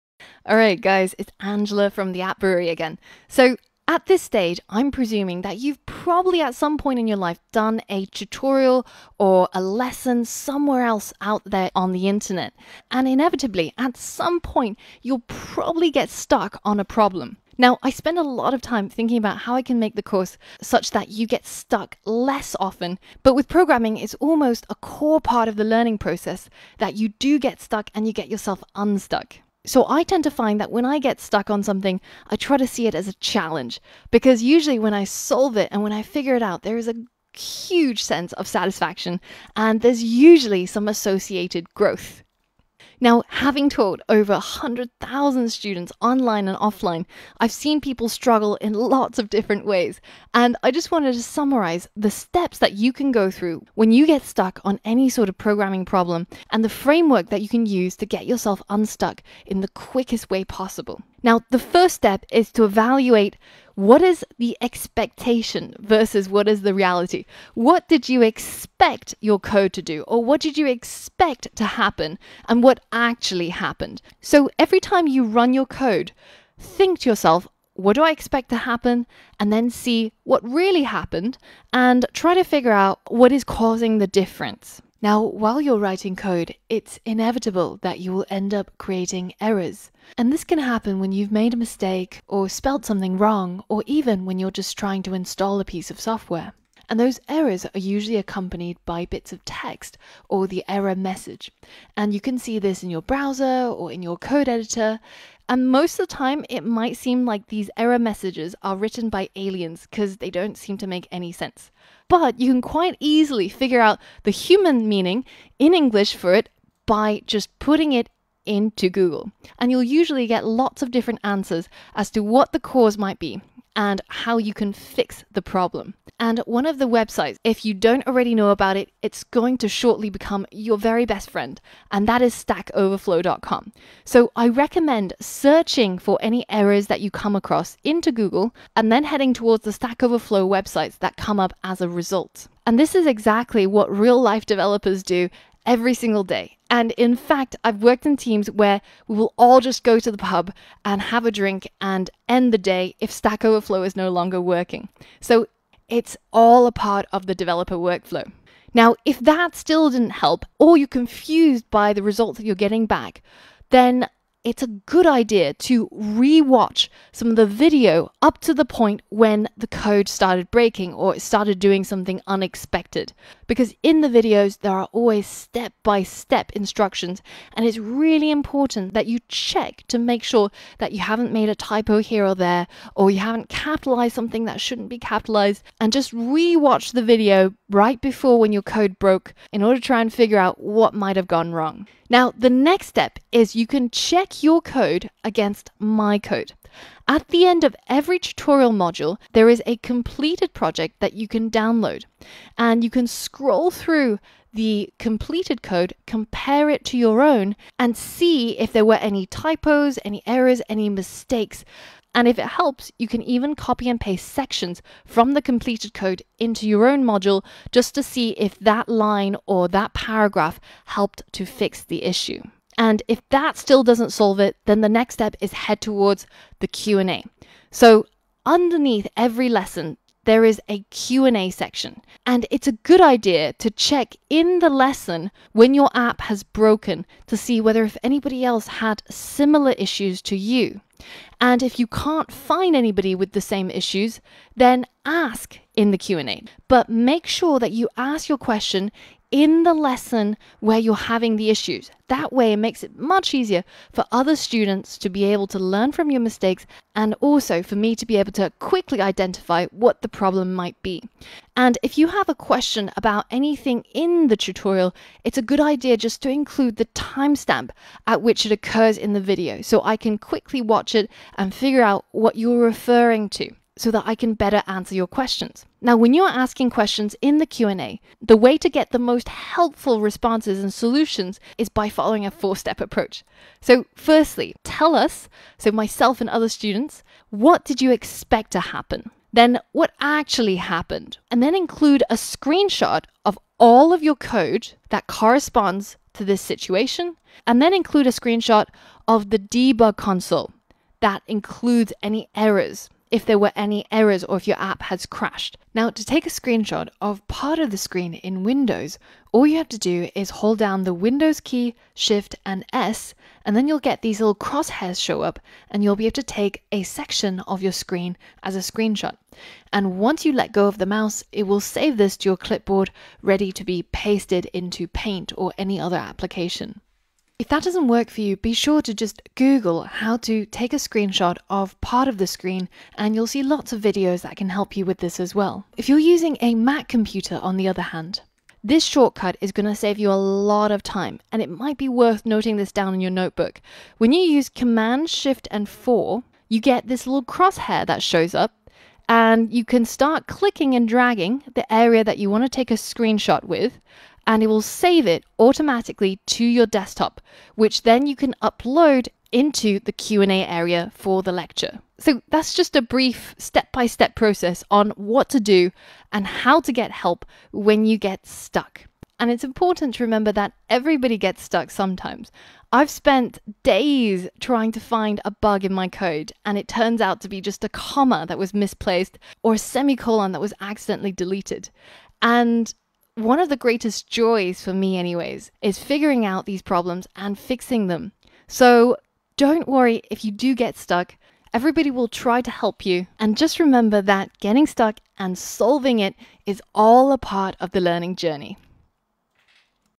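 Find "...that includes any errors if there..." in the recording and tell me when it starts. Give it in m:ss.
5:00.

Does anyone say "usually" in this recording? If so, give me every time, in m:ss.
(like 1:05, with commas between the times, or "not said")
0:34, 0:40, 1:37, 1:59.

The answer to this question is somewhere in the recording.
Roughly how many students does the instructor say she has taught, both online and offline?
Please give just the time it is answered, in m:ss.
0:44.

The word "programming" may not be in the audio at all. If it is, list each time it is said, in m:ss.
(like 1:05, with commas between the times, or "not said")
0:23, 0:55.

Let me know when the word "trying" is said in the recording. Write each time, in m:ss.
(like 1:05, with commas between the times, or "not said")
1:34, 6:14.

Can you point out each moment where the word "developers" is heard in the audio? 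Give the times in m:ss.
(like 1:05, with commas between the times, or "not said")
2:24, 2:37.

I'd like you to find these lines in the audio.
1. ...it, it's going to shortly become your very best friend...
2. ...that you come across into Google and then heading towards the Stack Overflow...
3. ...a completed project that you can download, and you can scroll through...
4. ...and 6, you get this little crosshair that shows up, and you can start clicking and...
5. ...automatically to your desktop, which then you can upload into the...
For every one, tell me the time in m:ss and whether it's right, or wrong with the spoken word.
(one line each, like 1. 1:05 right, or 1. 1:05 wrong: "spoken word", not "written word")
1. 2:08 right
2. 2:16 right
3. 3:19 right
4. 5:45 wrong: "4", not "6"
5. 5:55 right.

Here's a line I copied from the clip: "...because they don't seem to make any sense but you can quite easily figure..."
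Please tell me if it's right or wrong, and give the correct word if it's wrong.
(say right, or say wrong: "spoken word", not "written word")
right.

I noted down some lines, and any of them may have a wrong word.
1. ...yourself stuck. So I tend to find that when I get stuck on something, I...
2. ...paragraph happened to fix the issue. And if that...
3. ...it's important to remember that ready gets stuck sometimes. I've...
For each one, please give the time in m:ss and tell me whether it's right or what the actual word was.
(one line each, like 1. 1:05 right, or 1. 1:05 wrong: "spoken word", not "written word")
1. 0:28 wrong: "unstuck", not "stuck"
2. 3:39 wrong: "helped", not "happened"
3. 6:09 wrong: "everybody", not "ready".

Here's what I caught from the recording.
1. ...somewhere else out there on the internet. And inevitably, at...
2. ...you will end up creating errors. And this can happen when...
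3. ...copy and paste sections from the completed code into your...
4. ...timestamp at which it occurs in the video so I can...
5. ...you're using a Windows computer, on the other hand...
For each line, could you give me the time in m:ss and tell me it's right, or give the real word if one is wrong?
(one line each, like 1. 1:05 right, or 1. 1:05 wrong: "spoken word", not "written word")
1. 0:10 right
2. 1:27 right
3. 3:33 right
4. 4:26 right
5. 5:35 wrong: "Mac", not "Windows".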